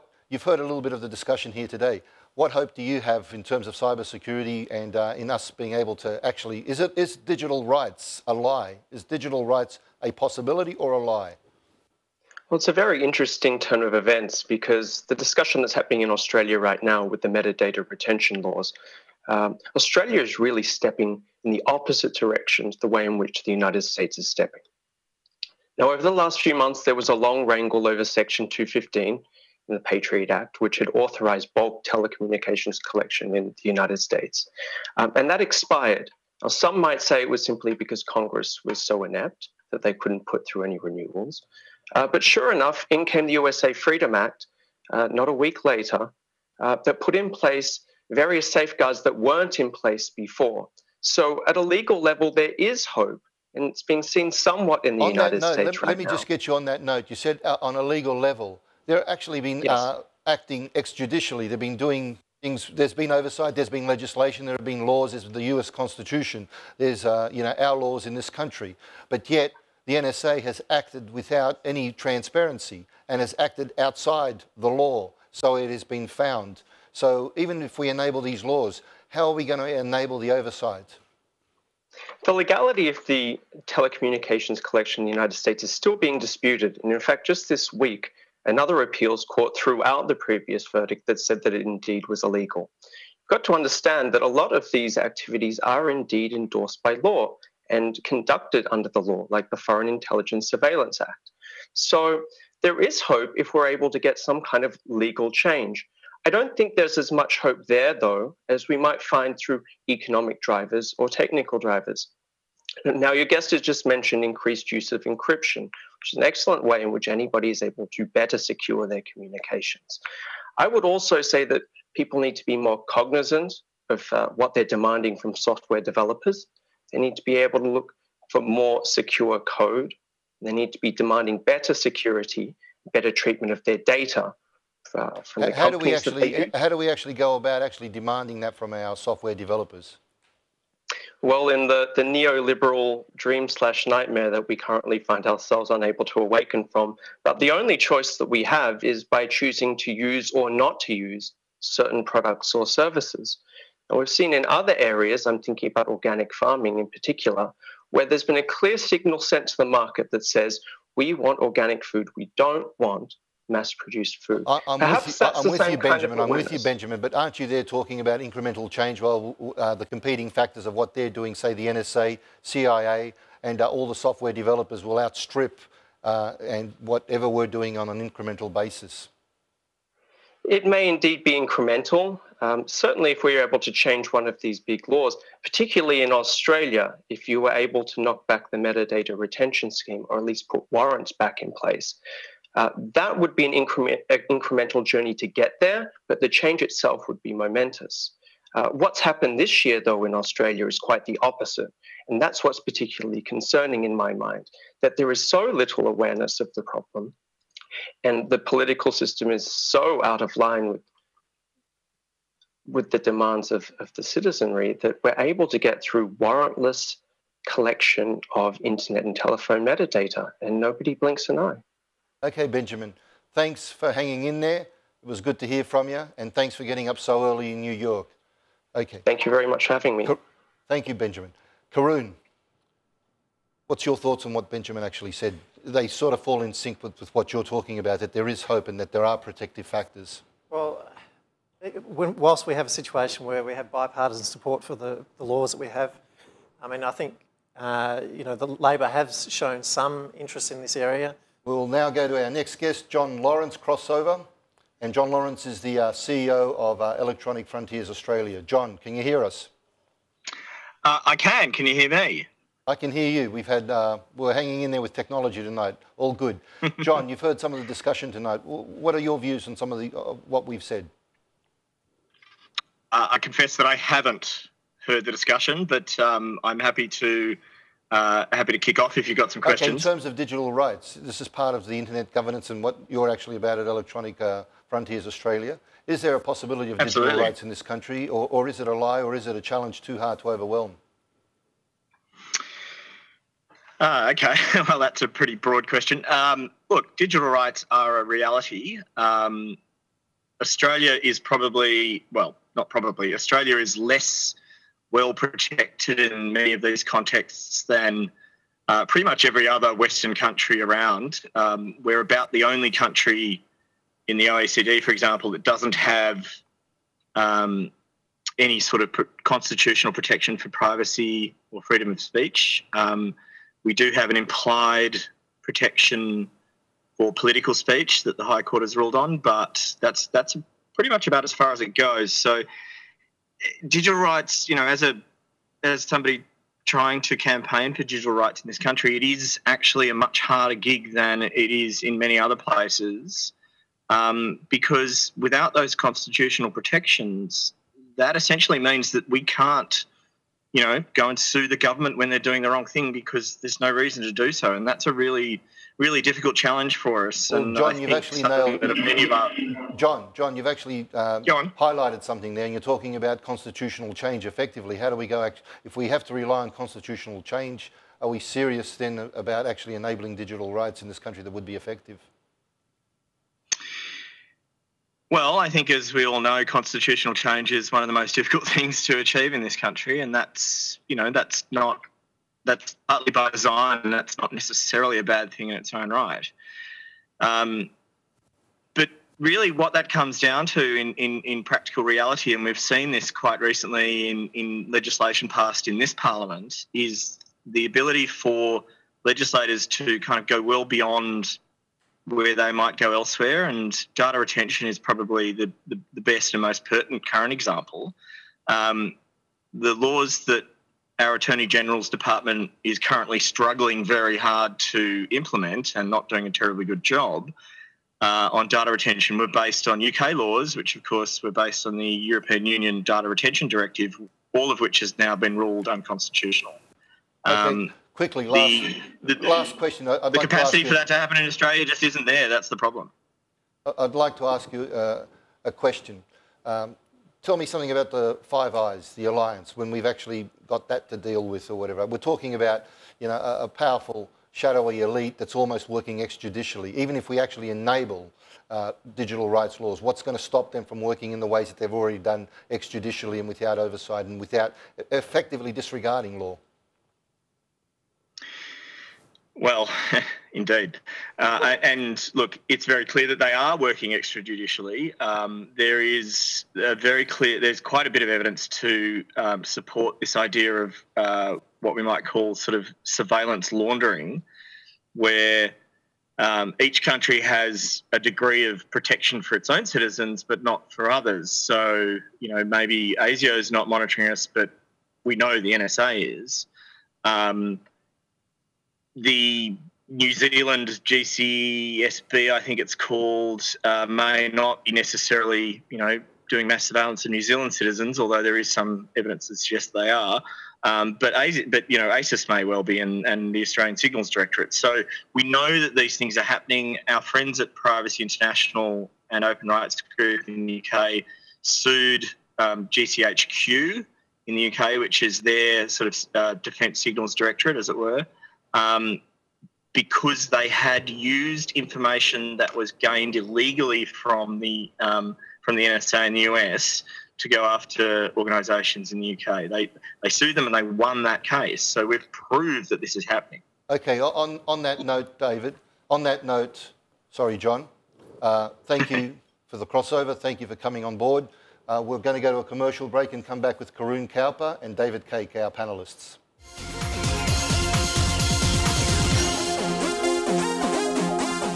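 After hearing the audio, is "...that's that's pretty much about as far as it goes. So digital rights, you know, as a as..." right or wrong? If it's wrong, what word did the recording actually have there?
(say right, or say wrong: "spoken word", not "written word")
right.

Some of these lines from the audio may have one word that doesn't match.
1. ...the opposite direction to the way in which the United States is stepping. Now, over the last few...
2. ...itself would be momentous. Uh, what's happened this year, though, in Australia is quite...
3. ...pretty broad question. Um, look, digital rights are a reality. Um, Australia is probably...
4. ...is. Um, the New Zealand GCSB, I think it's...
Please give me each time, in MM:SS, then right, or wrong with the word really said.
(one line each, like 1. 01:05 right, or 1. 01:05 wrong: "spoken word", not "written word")
1. 00:21 right
2. 03:16 right
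3. 04:55 right
4. 08:06 right.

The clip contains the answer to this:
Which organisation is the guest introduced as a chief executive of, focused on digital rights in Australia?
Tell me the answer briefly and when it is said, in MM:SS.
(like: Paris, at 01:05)
Electronic Frontiers Australia, at 04:16.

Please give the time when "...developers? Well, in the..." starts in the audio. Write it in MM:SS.
02:19.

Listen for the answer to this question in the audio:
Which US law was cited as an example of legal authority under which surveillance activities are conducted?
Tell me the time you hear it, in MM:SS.
01:39.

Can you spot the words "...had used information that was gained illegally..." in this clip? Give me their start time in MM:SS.
08:40.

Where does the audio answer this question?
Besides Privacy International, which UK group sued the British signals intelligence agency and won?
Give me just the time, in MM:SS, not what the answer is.
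08:29.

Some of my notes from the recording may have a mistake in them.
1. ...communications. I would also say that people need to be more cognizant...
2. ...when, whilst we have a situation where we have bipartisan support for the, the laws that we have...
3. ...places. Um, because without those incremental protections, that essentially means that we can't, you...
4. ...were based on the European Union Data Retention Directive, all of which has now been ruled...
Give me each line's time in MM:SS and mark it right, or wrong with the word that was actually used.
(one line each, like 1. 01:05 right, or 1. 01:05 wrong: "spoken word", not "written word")
1. 01:59 right
2. 04:01 right
3. 05:42 wrong: "constitutional", not "incremental"
4. 07:01 right.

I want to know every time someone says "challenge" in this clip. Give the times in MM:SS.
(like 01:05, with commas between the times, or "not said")
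04:49, 05:56.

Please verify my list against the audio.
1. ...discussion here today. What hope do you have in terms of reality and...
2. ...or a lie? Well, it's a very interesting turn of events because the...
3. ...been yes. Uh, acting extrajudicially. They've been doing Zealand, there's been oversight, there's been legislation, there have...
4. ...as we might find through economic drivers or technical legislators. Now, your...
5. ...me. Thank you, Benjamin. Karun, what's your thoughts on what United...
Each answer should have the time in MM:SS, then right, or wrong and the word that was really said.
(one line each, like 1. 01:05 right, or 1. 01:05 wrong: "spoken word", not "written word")
1. 00:01 wrong: "cybersecurity", not "reality"
2. 00:10 right
3. 00:59 wrong: "Things", not "Zealand"
4. 01:48 wrong: "drivers", not "legislators"
5. 03:49 wrong: "Benjamin", not "United".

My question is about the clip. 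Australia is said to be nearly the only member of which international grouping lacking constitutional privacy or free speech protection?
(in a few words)
OECD.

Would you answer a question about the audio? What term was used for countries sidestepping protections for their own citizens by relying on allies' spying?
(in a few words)
Surveillance laundering.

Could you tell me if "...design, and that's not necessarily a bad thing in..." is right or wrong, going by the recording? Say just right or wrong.
right.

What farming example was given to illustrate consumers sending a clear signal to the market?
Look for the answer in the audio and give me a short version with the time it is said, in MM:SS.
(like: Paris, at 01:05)
Organic farming, at 02:35.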